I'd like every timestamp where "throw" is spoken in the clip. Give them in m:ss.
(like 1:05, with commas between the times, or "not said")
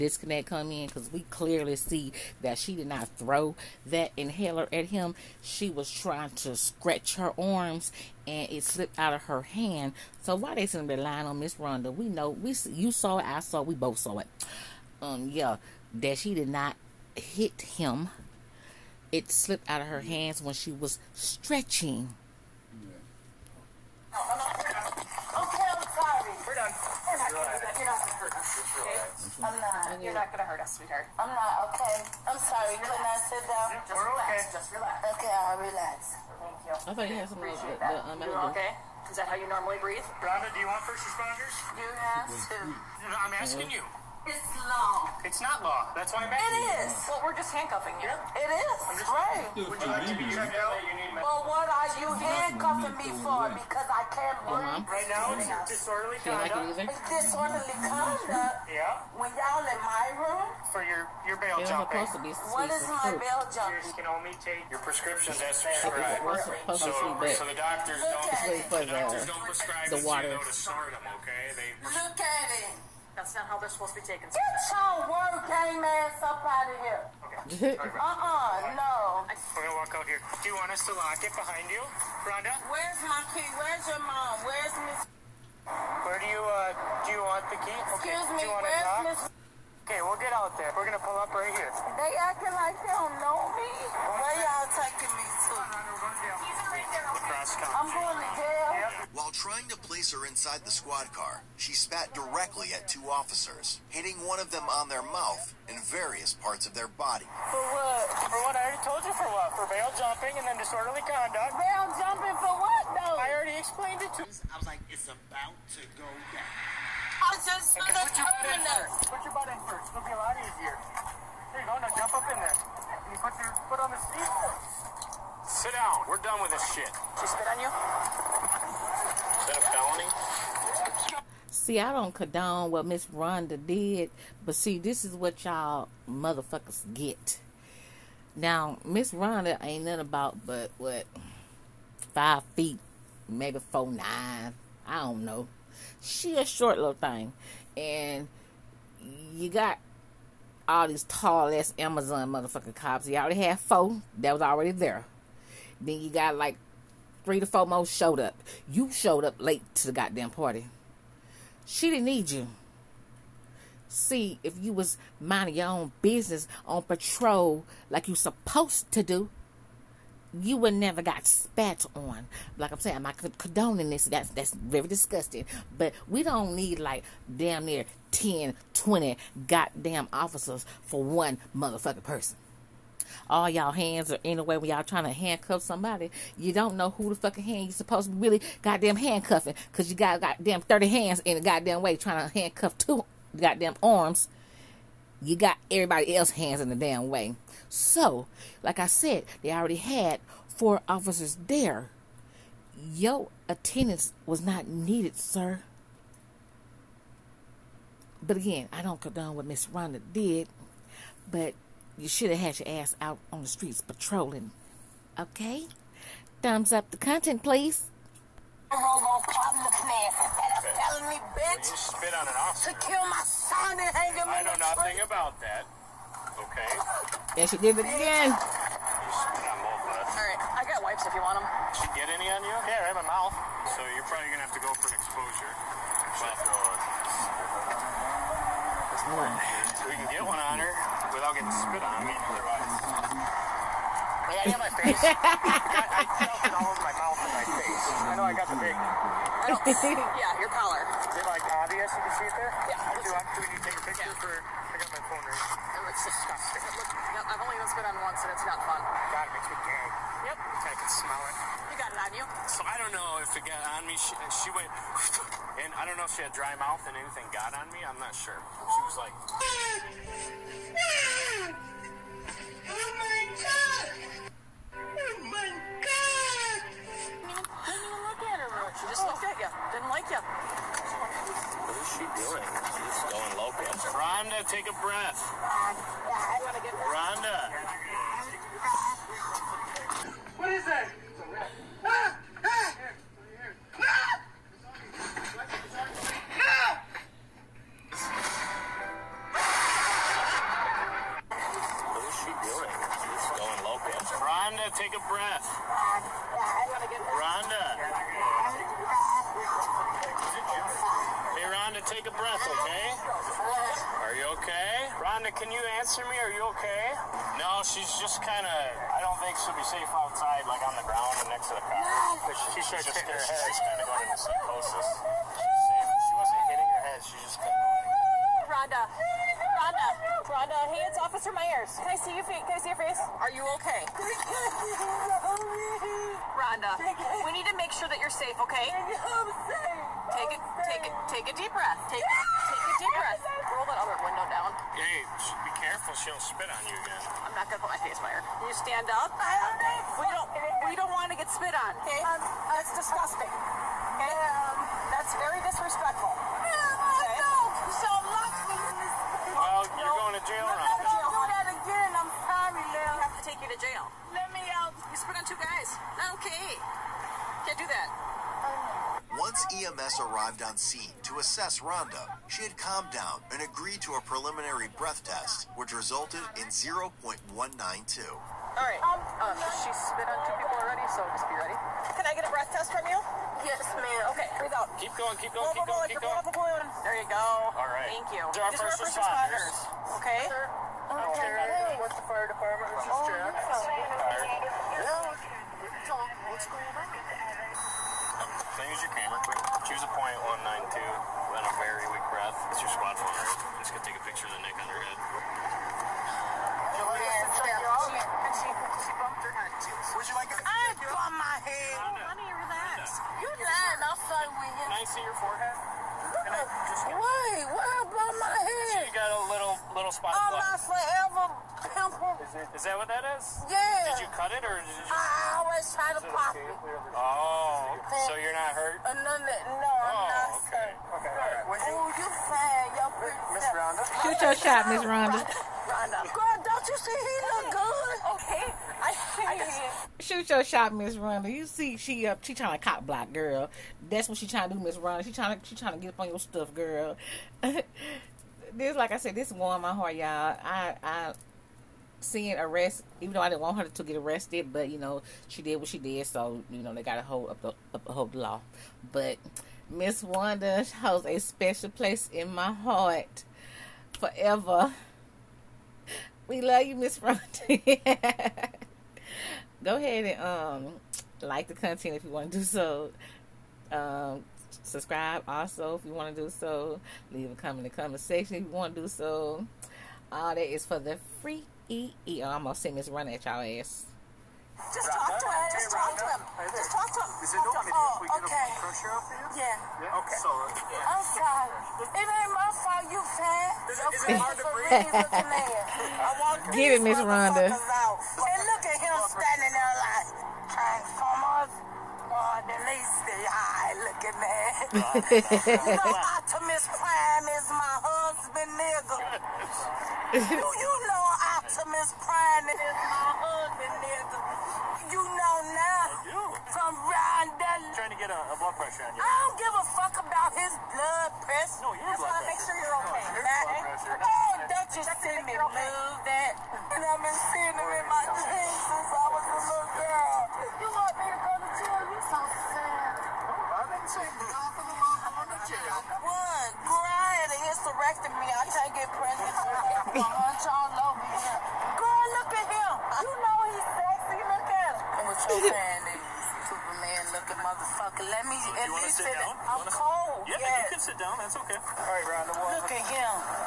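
0:03.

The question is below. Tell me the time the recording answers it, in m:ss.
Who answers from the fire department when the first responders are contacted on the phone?
6:32.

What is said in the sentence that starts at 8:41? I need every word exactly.
No, your That's blood why I make sure you're okay.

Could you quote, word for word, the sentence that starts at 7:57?
Leave a comment in the comment section if you want to do so.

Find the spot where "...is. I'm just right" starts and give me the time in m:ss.
0:48.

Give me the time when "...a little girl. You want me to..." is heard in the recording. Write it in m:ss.
8:49.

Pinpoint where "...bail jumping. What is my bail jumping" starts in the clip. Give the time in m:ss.
1:01.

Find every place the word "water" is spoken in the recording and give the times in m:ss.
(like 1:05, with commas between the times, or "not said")
1:10.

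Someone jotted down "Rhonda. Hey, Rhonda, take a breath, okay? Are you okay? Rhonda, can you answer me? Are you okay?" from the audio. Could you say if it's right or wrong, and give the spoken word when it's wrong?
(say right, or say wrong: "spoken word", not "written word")
right.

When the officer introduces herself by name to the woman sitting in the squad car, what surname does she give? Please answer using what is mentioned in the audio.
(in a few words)
Myers.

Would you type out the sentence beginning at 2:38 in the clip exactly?
You showed up late to the goddamn party.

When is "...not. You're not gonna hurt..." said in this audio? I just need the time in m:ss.
0:29.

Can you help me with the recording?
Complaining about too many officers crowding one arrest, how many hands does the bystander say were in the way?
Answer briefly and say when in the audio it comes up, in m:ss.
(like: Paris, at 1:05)
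30, at 3:10.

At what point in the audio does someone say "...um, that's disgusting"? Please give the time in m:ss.
5:52.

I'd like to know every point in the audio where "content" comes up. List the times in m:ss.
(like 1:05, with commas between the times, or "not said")
3:36, 7:51.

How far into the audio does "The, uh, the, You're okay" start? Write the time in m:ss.
0:37.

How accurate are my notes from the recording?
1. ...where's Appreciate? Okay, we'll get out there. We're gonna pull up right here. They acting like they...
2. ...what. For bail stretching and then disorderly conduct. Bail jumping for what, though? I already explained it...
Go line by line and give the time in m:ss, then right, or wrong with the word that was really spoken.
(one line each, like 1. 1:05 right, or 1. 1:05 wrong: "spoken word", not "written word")
1. 1:28 wrong: "Miss", not "Appreciate"
2. 1:49 wrong: "jumping", not "stretching".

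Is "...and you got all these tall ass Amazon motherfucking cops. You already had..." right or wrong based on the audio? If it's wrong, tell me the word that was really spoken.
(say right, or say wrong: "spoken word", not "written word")
right.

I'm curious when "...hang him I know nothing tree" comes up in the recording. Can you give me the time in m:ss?
3:43.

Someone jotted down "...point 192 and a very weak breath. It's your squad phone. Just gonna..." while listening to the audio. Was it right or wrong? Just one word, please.
right.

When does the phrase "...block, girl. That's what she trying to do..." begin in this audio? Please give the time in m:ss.
7:22.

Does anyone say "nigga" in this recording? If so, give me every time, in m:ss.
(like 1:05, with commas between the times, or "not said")
8:28, 8:33.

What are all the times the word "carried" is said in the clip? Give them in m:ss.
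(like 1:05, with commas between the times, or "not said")
not said.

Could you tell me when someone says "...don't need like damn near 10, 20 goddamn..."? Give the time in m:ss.
2:56.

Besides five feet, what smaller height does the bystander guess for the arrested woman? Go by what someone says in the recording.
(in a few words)
four nine.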